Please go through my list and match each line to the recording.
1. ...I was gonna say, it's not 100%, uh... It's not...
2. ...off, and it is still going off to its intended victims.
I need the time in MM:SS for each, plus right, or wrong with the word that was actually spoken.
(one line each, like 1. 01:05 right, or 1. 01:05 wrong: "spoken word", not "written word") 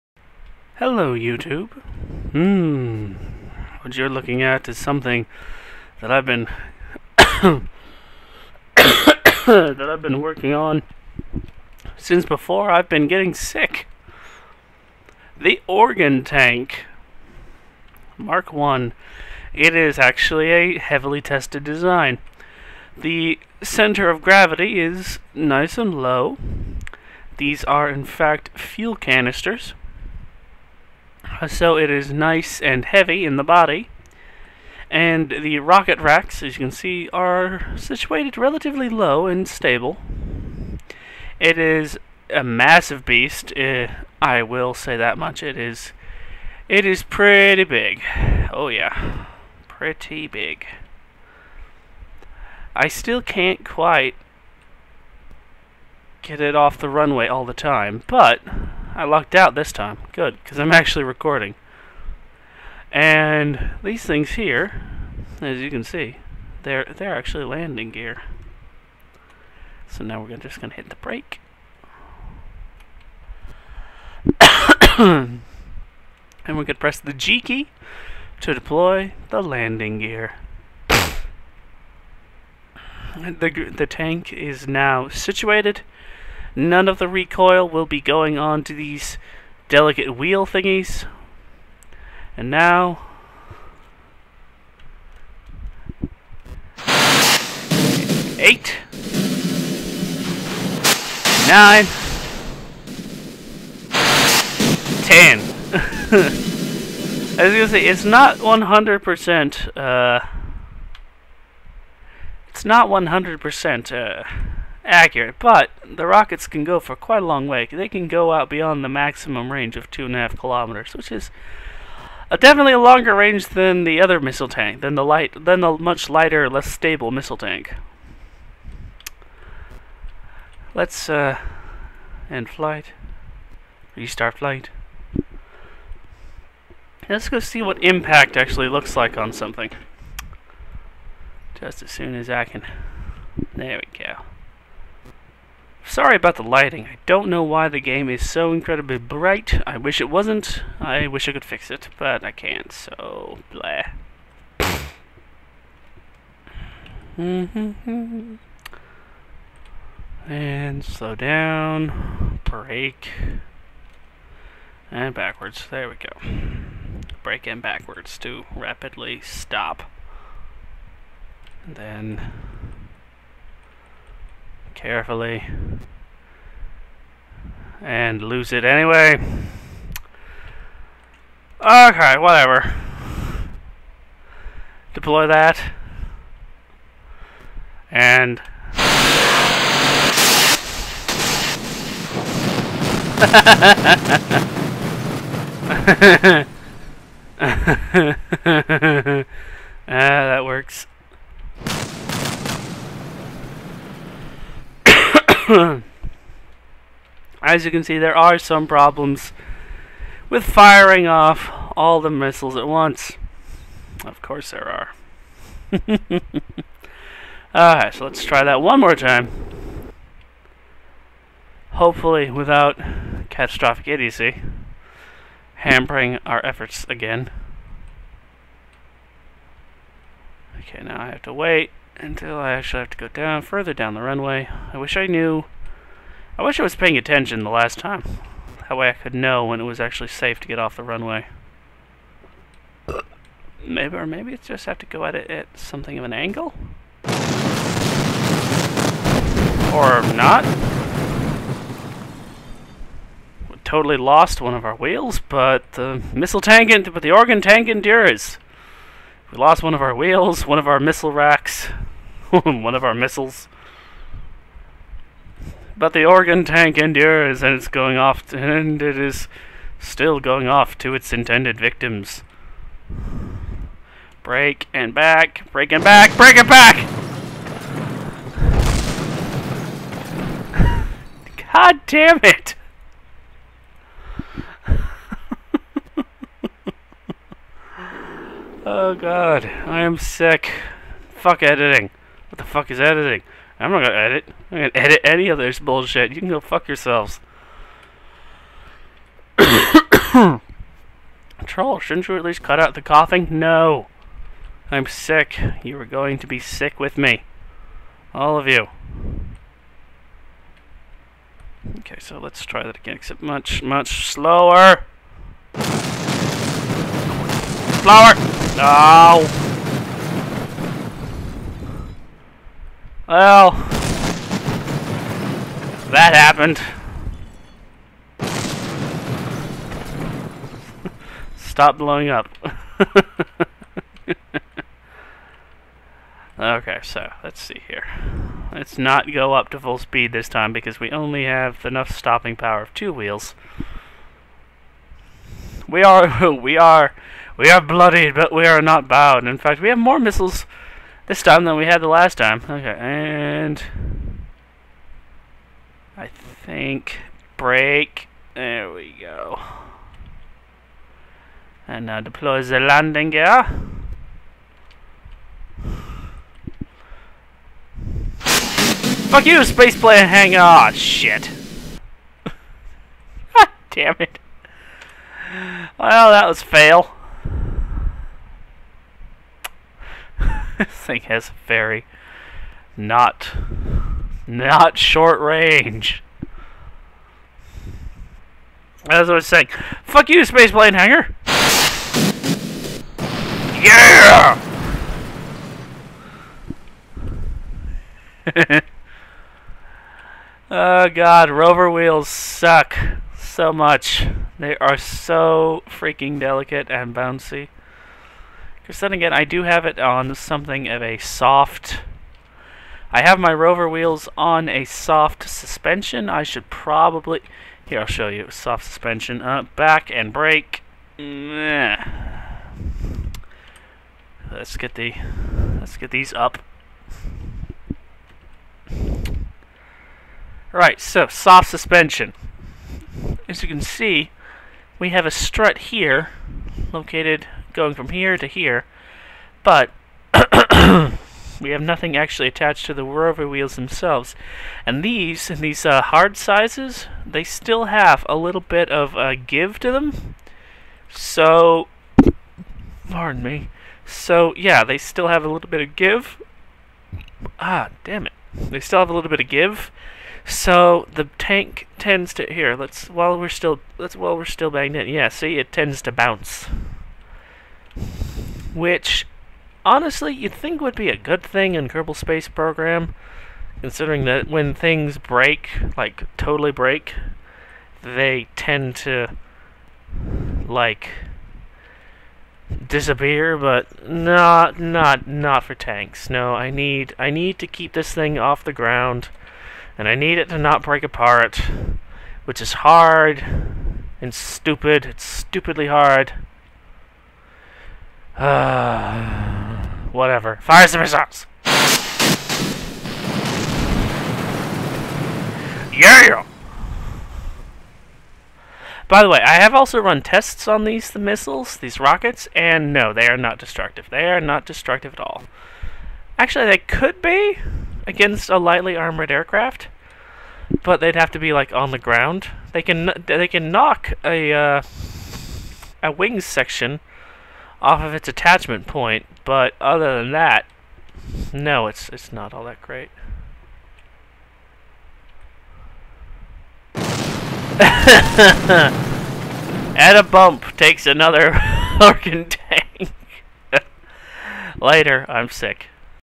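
1. 01:47 right
2. 04:27 right.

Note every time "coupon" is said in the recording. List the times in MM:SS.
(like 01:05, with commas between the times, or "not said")
not said.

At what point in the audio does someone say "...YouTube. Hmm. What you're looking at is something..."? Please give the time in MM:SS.
00:01.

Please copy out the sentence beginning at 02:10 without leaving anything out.
Let's uh, end flight, restart flight.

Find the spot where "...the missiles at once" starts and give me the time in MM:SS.
03:31.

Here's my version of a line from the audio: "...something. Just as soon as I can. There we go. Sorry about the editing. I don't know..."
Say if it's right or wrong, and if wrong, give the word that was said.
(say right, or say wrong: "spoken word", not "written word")
wrong: "lighting", not "editing".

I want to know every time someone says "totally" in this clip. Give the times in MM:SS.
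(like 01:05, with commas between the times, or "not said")
04:13, 07:56.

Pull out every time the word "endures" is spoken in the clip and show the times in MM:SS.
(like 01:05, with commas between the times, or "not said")
04:17, 04:26.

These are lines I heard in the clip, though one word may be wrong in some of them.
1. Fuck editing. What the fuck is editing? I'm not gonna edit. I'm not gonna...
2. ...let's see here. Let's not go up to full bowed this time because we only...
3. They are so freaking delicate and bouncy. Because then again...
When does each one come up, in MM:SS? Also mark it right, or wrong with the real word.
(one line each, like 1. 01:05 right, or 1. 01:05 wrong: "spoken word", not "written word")
1. 04:51 right
2. 05:37 wrong: "speed", not "bowed"
3. 06:44 right.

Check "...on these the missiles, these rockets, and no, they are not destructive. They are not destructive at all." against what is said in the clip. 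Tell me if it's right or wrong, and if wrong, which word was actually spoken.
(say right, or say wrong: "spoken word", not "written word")
right.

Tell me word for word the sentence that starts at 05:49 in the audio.
In fact, we have more missiles this time than we had the last time.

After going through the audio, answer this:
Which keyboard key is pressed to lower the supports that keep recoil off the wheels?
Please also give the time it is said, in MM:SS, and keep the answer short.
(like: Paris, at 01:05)
G, at 01:17.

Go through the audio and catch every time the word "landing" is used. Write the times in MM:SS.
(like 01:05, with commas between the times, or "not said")
01:07, 01:19, 06:02.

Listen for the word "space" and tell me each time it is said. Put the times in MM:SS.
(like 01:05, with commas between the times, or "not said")
06:09, 06:30, 07:51.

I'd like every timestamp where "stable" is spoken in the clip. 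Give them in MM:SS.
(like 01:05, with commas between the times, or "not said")
00:39, 02:06.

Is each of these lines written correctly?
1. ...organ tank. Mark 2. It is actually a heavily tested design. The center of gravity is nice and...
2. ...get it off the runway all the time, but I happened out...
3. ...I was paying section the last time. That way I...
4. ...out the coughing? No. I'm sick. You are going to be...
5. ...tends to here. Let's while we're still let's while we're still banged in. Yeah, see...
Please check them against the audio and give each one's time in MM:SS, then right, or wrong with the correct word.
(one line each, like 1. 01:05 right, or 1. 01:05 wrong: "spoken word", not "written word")
1. 00:15 wrong: "1", not "2"
2. 00:56 wrong: "lucked", not "happened"
3. 03:56 wrong: "attention", not "section"
4. 05:02 right
5. 07:41 right.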